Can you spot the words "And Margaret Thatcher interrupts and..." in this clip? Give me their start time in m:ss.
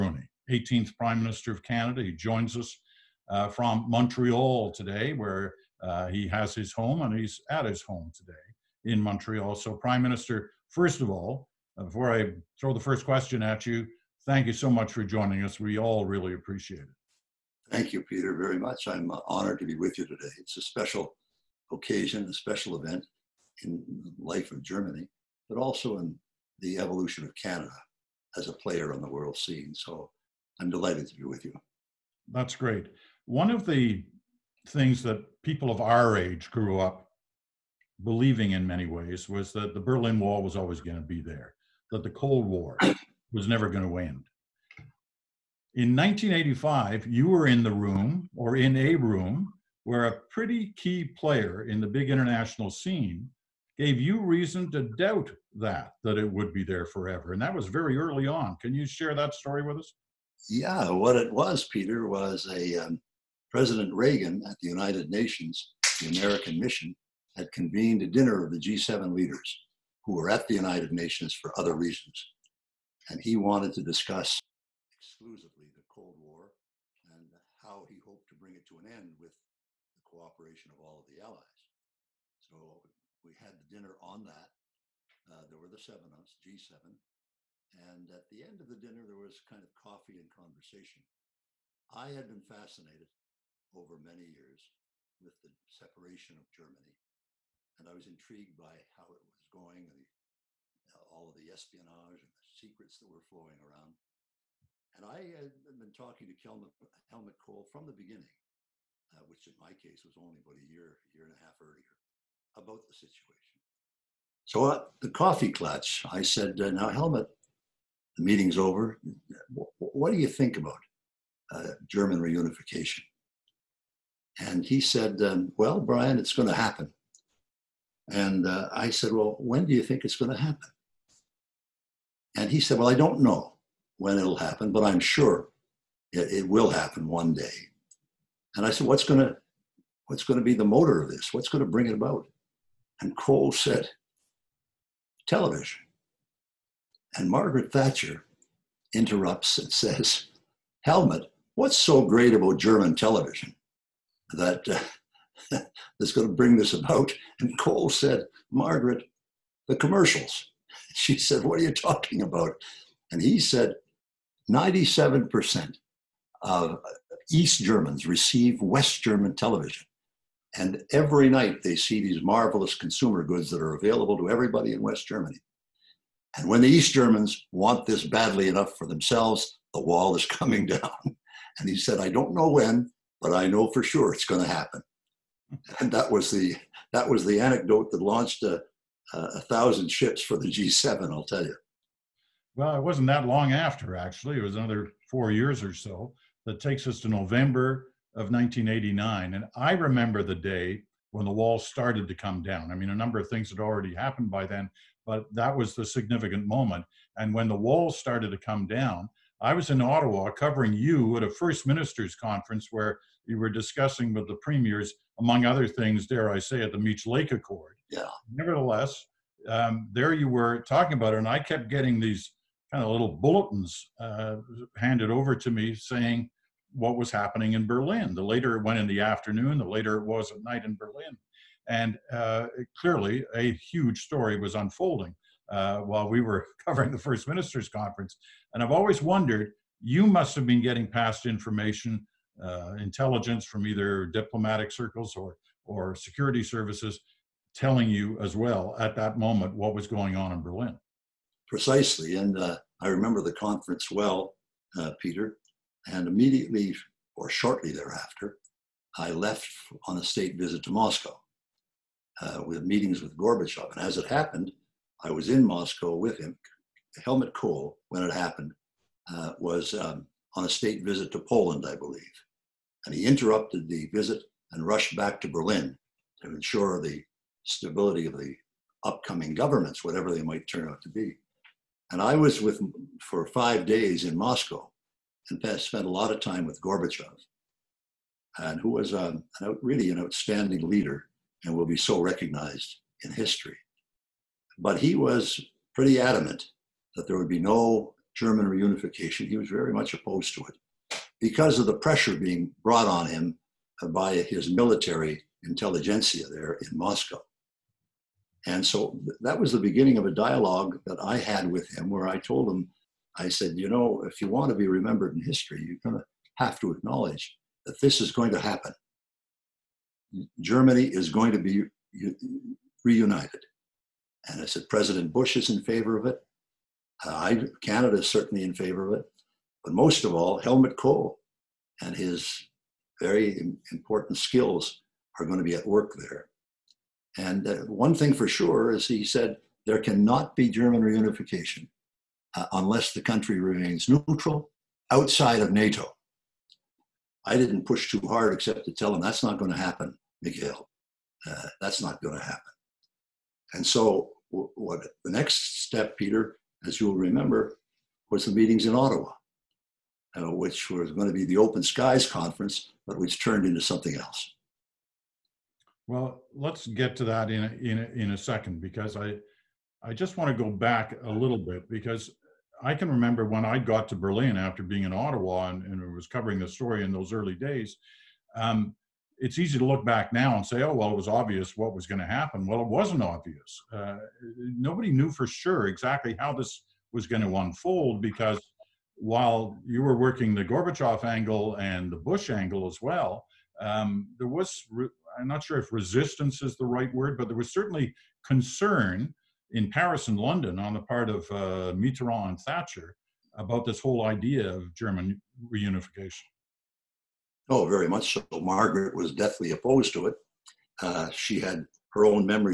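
2:27.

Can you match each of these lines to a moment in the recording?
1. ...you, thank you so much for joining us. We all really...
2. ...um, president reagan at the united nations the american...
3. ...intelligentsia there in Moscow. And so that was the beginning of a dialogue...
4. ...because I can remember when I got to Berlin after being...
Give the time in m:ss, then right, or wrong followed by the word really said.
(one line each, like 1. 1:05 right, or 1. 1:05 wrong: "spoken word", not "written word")
1. 0:13 right
2. 1:02 right
3. 5:05 right
4. 6:11 right.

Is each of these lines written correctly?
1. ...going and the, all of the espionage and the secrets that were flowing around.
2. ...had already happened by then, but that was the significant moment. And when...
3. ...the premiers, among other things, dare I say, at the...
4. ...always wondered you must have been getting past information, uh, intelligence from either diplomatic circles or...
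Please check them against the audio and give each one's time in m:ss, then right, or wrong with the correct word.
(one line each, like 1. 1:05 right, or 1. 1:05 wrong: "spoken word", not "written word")
1. 1:39 right
2. 3:23 right
3. 3:34 right
4. 3:58 right.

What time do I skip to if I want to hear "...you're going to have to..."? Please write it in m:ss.
5:15.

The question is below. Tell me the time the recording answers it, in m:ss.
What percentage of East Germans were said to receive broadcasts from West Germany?
2:44.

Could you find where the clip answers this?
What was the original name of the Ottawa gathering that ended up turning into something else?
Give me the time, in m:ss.
6:01.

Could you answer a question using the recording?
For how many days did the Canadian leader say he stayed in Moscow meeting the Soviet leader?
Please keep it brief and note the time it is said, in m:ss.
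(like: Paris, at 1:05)
5, at 4:43.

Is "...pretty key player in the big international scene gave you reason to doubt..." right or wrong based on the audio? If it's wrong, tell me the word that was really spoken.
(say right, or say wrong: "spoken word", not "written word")
right.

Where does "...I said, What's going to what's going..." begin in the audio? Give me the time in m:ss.
2:18.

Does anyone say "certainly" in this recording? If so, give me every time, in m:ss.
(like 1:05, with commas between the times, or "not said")
5:28, 6:37.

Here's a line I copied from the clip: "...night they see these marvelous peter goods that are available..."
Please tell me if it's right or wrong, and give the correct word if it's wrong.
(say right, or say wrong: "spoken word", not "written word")
wrong: "consumer", not "peter".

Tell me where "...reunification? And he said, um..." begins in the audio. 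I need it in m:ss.
2:02.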